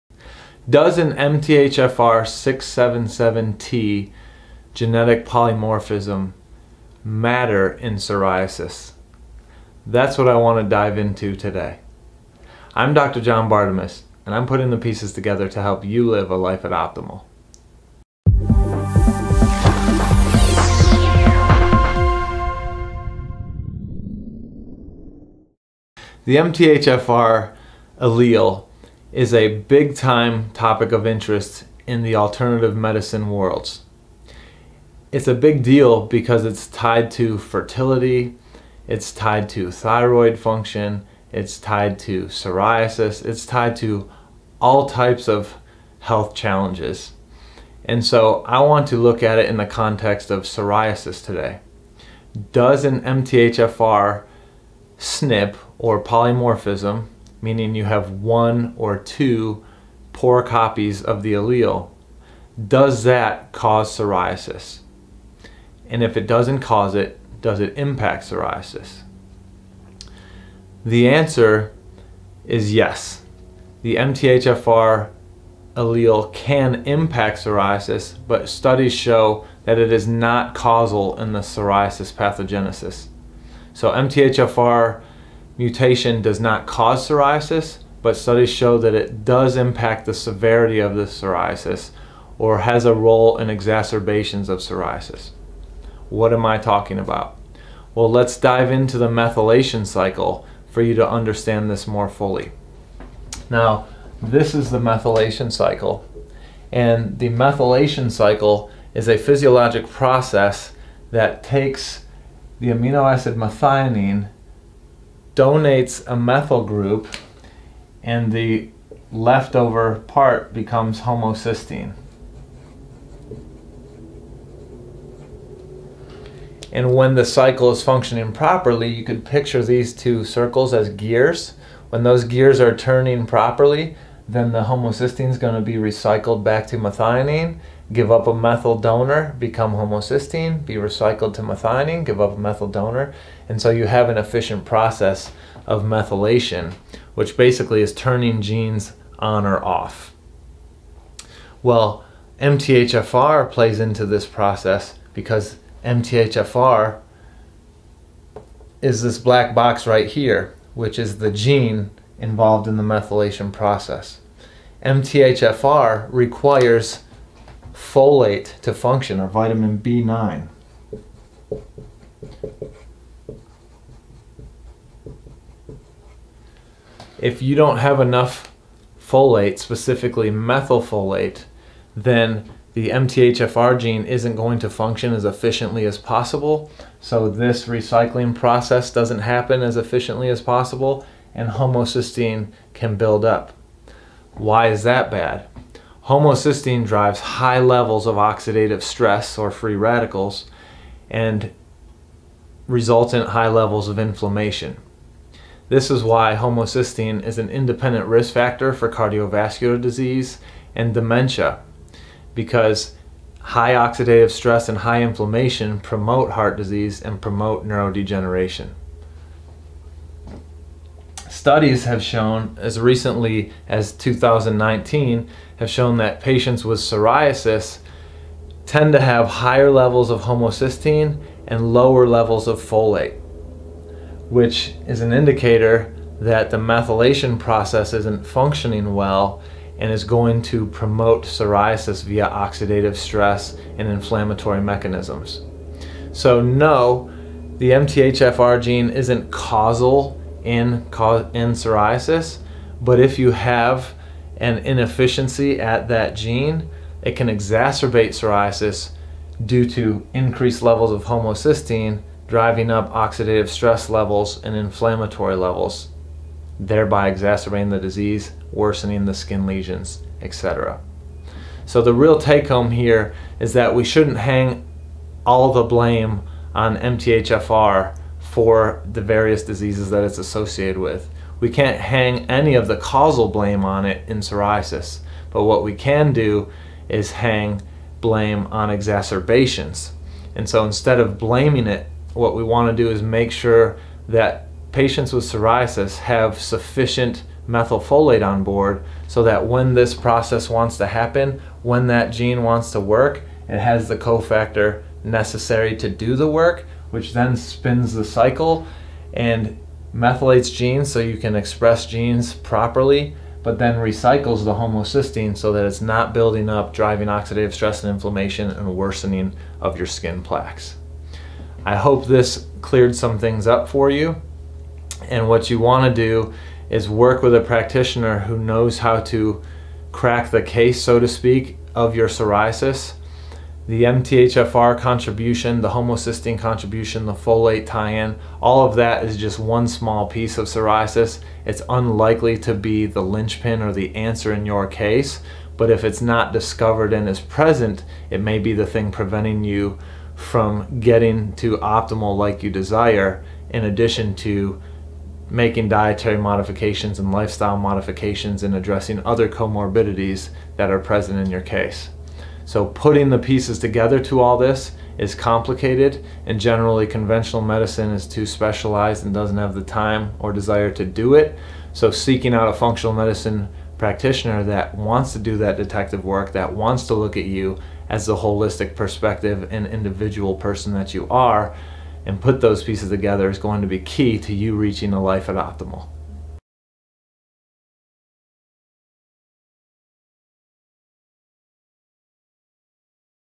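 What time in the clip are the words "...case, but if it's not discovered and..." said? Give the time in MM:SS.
05:44.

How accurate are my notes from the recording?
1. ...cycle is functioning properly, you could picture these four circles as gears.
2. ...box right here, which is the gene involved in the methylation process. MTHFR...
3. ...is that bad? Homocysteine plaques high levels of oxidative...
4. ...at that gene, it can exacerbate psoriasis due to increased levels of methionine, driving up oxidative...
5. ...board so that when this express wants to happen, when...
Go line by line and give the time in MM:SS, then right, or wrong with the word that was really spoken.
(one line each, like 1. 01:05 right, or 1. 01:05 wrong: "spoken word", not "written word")
1. 02:07 wrong: "two", not "four"
2. 02:39 right
3. 03:14 wrong: "drives", not "plaques"
4. 04:15 wrong: "homocysteine", not "methionine"
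5. 04:58 wrong: "process", not "express".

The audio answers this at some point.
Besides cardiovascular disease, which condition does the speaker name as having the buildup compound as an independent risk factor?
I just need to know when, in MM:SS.
03:30.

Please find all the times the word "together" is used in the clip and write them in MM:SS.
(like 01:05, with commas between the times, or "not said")
00:15, 06:03, 06:22.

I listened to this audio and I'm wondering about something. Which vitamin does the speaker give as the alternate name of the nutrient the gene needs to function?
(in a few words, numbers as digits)
vitamin B9.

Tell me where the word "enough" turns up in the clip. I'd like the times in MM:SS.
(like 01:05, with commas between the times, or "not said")
02:57.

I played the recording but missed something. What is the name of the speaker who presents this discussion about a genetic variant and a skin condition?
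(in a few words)
John Bartemus.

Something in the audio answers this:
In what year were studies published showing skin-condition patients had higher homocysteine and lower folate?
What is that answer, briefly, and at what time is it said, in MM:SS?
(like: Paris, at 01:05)
2019, at 03:43.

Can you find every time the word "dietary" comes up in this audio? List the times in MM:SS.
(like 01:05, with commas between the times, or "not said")
05:55.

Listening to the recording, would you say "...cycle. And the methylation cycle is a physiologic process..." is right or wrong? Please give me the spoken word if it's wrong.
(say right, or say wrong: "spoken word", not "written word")
right.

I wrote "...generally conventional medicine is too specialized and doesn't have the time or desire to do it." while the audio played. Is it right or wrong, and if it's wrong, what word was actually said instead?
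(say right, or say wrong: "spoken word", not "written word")
right.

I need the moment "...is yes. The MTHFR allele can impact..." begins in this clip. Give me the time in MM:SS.
01:12.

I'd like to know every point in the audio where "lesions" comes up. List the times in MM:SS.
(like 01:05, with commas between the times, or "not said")
04:29.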